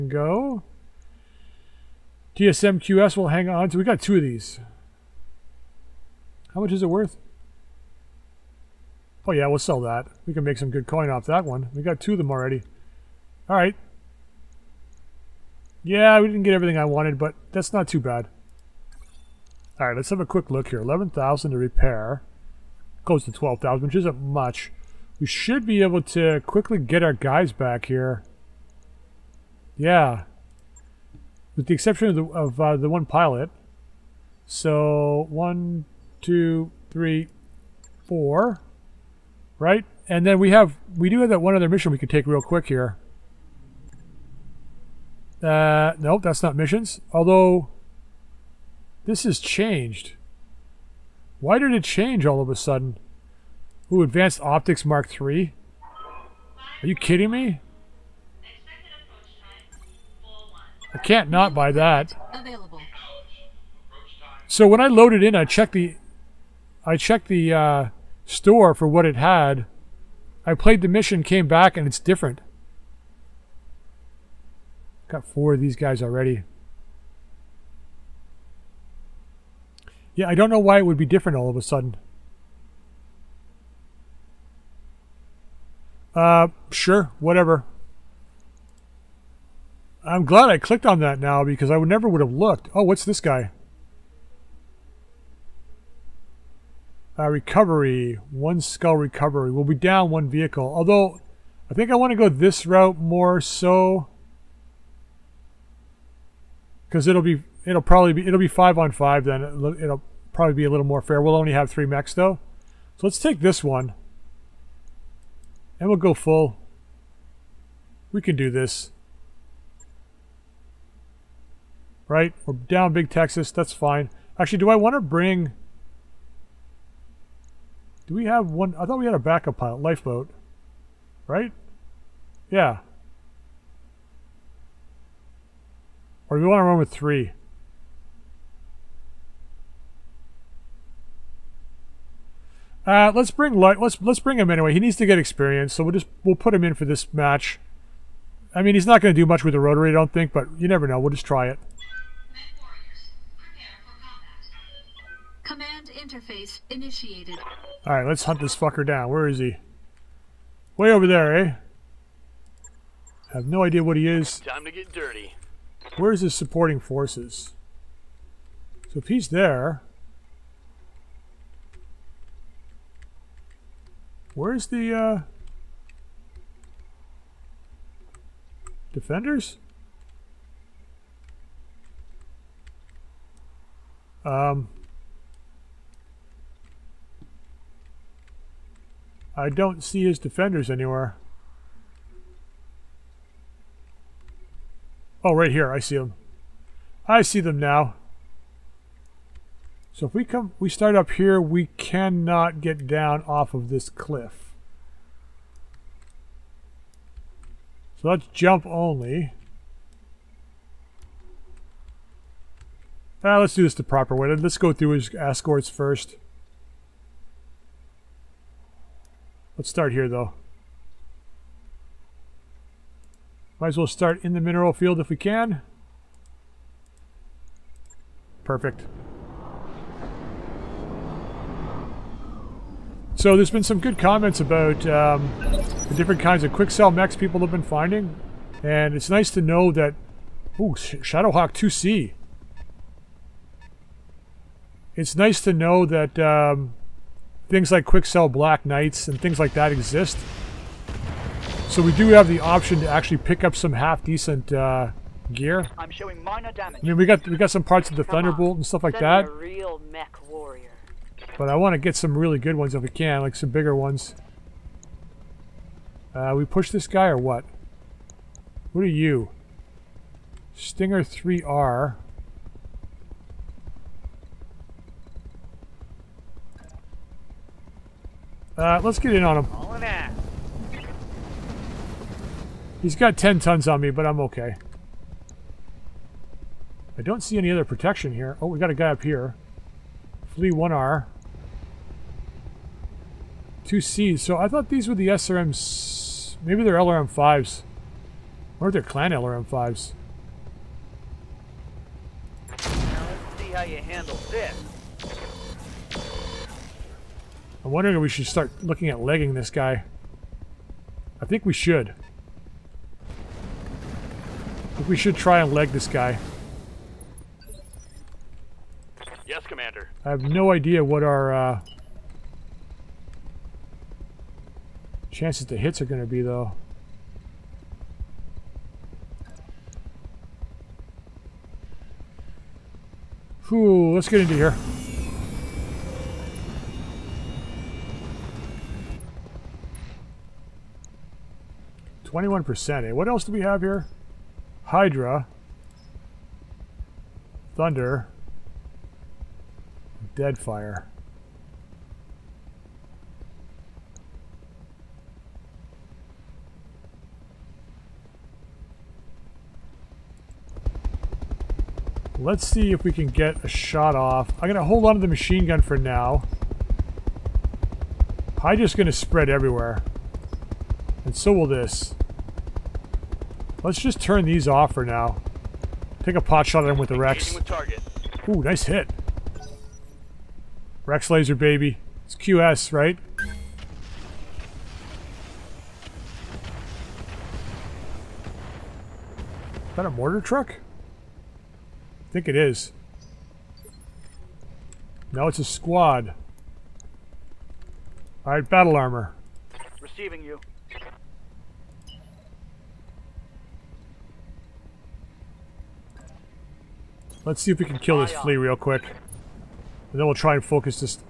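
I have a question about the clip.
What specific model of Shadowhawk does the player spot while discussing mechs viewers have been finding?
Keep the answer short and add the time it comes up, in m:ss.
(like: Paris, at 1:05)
Shadowhawk 2C, at 4:00.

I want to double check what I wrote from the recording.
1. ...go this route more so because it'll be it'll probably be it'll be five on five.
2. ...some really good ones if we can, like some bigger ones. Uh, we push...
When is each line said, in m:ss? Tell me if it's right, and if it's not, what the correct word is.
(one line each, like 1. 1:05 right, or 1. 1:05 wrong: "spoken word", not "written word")
1. 1:42 right
2. 4:21 right.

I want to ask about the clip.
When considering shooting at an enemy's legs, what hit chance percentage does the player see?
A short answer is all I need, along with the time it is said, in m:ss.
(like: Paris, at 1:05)
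21%, at 5:42.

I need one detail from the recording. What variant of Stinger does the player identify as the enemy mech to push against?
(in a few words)
Stinger 3R.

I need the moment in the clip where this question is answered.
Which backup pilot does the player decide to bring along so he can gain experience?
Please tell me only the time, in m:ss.
2:09.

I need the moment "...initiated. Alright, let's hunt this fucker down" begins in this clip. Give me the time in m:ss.
2:36.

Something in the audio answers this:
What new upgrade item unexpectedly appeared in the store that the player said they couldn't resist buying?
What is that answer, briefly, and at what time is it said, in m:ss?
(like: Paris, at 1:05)
Advanced Optics Mark 3, at 0:54.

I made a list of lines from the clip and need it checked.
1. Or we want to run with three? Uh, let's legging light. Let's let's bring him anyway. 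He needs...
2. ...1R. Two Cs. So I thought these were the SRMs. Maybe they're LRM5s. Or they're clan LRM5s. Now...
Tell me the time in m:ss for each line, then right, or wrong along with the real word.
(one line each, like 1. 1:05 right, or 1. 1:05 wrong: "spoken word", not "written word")
1. 2:16 wrong: "bring", not "legging"
2. 4:50 right.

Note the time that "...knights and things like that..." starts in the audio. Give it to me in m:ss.
4:08.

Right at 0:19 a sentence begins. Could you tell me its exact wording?
All right, let's have a quick look here.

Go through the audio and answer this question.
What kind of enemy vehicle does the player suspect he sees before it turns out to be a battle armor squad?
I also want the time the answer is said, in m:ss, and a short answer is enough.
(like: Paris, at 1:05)
Mortar truck, at 6:29.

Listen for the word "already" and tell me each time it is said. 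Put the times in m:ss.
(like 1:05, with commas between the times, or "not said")
0:12, 1:16.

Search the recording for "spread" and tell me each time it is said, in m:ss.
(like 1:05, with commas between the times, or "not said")
6:08.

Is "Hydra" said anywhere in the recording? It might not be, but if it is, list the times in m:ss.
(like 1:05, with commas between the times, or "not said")
5:44, 6:08.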